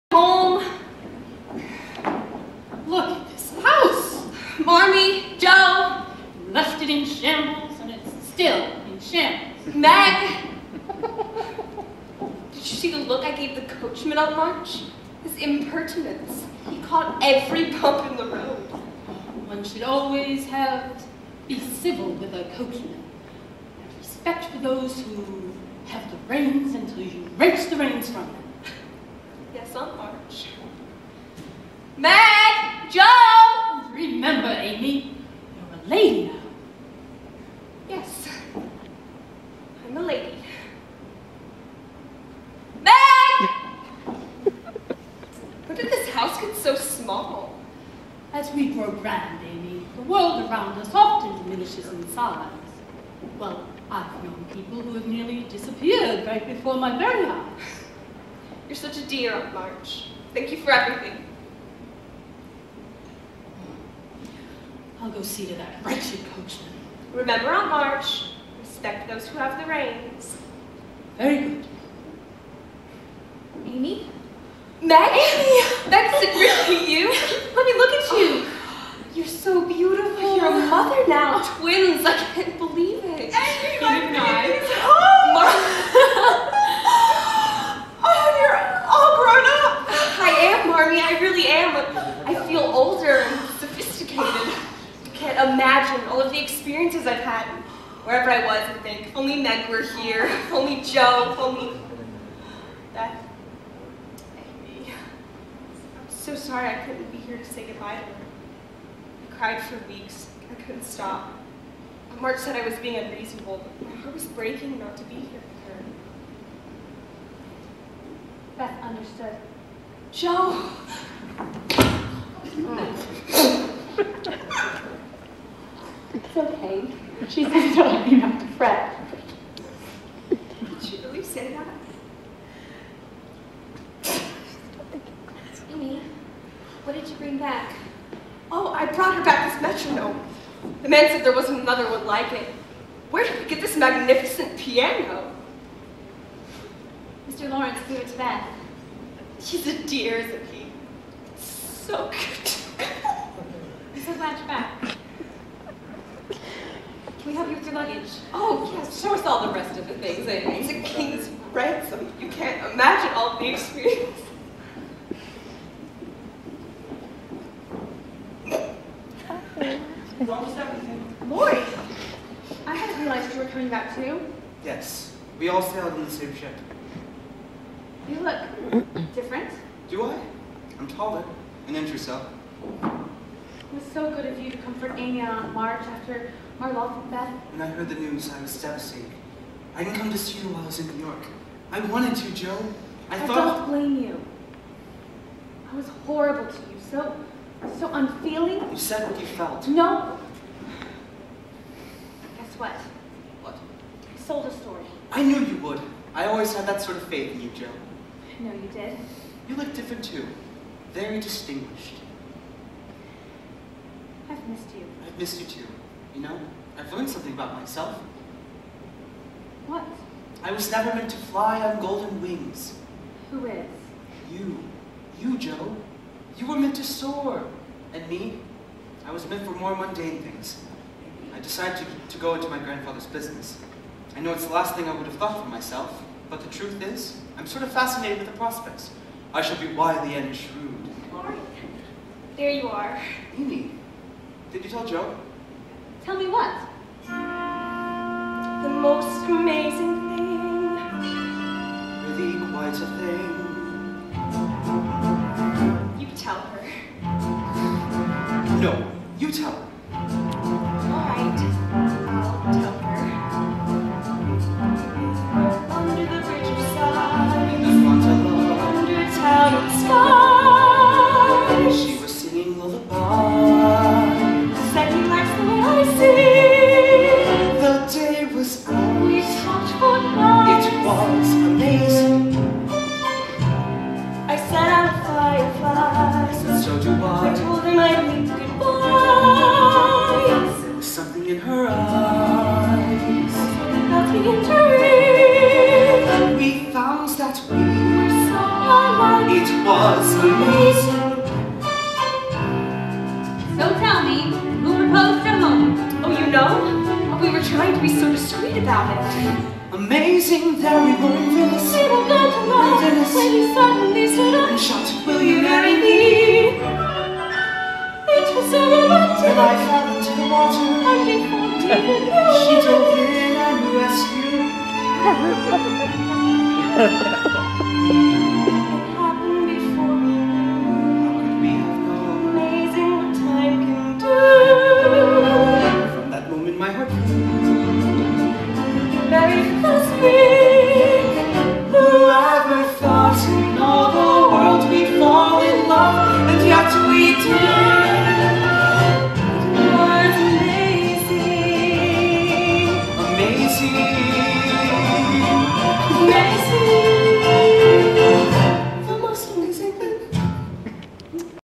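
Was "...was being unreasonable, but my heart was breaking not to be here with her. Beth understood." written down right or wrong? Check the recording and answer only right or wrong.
right.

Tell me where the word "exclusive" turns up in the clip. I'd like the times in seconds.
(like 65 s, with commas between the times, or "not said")
not said.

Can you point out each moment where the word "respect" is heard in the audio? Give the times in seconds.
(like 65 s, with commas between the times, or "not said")
23 s, 68 s.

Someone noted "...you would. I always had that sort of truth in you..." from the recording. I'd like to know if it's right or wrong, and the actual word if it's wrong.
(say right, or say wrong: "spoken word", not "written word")
wrong: "faith", not "truth".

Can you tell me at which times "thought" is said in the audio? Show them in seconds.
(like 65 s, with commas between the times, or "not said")
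193 s, 235 s.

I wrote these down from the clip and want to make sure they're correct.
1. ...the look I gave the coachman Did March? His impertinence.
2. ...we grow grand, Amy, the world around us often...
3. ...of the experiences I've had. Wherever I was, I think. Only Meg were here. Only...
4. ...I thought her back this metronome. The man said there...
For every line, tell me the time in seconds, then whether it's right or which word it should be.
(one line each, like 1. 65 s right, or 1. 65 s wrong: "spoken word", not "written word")
1. 12 s wrong: "Aunt", not "Did"
2. 48 s right
3. 96 s right
4. 138 s wrong: "brought", not "thought".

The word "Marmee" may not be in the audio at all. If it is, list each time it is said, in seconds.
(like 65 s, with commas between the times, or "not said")
4 s, 90 s.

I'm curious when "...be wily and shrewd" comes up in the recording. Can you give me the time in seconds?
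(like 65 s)
239 s.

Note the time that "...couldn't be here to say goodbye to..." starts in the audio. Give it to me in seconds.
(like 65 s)
106 s.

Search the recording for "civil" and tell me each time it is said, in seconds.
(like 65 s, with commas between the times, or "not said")
21 s.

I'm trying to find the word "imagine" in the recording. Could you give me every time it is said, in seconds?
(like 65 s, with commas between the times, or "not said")
95 s, 162 s.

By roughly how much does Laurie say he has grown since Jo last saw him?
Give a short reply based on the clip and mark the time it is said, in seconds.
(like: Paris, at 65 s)
An inch or so, at 181 s.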